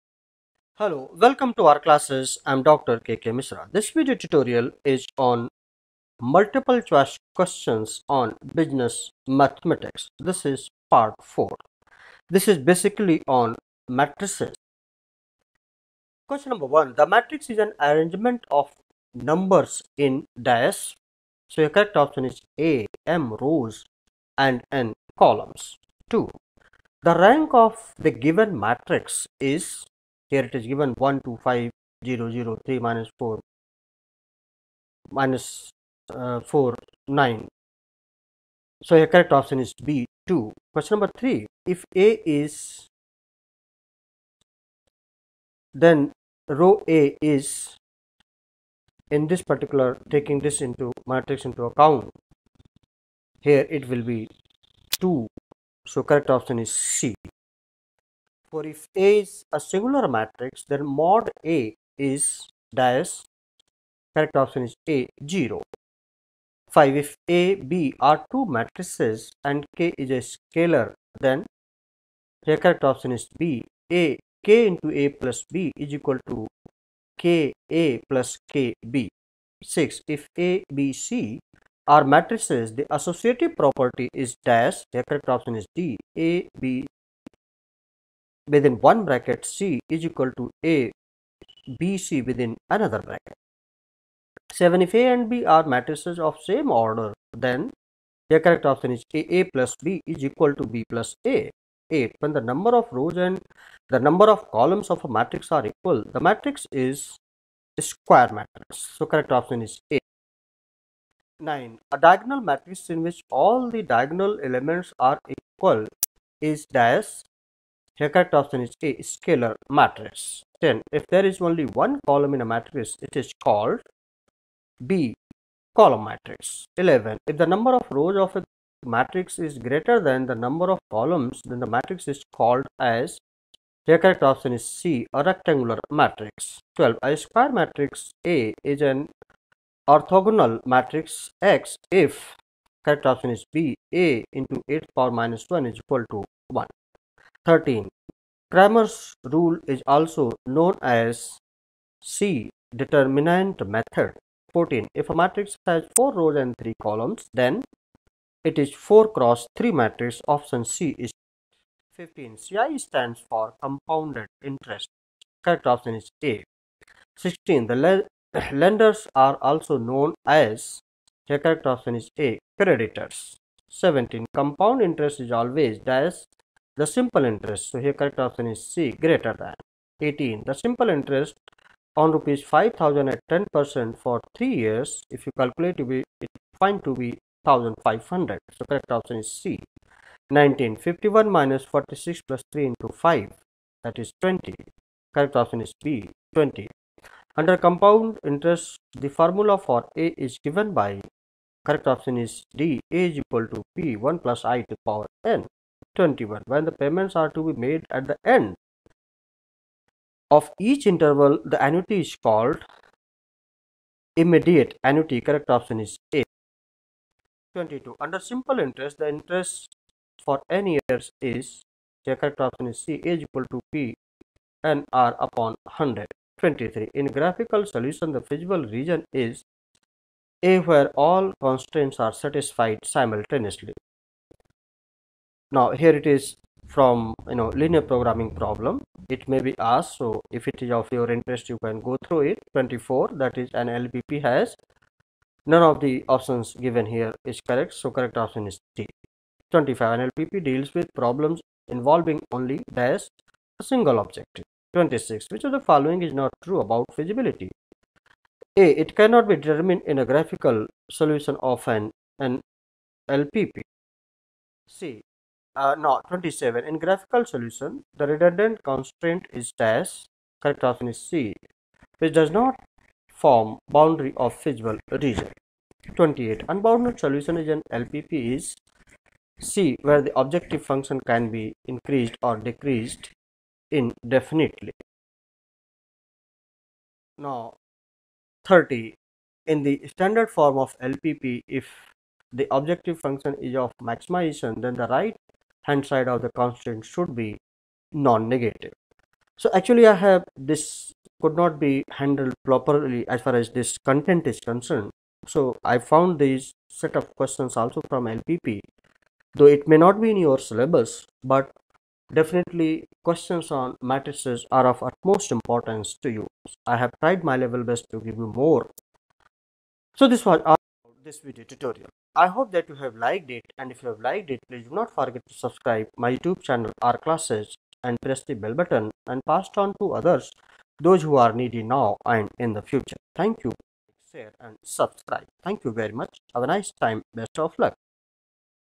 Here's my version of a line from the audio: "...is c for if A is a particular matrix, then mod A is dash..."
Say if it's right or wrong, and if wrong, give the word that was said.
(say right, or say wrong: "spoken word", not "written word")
wrong: "singular", not "particular".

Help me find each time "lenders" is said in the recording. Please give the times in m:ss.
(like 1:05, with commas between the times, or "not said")
2:48.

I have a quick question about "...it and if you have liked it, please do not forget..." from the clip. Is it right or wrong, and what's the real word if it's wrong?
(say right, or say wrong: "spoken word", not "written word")
right.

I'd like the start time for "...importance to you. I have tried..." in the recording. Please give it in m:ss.
5:15.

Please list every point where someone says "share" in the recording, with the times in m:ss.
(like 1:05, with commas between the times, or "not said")
5:34.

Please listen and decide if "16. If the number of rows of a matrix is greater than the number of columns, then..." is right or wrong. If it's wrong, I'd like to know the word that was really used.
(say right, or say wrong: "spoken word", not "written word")
wrong: "11", not "16".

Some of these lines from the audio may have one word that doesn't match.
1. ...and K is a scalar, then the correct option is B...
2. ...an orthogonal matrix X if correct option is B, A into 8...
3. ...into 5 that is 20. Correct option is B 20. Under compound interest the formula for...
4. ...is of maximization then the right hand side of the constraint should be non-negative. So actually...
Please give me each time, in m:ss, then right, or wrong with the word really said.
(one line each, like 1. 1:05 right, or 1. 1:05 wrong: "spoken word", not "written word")
1. 1:09 right
2. 2:18 right
3. 3:12 right
4. 4:53 right.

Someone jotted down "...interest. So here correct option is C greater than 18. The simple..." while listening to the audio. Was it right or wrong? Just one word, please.
right.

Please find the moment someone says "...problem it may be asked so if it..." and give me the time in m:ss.
3:58.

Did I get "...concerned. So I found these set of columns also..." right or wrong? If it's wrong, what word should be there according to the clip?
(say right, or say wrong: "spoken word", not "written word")
wrong: "questions", not "columns".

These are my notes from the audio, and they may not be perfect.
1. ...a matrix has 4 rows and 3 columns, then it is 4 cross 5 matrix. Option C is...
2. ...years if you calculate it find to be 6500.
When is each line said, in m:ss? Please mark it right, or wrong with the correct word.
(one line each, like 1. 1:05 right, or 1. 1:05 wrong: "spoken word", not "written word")
1. 2:35 wrong: "3", not "5"
2. 3:04 wrong: "1500", not "6500".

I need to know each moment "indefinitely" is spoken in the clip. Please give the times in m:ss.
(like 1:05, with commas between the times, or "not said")
4:43.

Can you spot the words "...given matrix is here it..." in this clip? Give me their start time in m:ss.
0:28.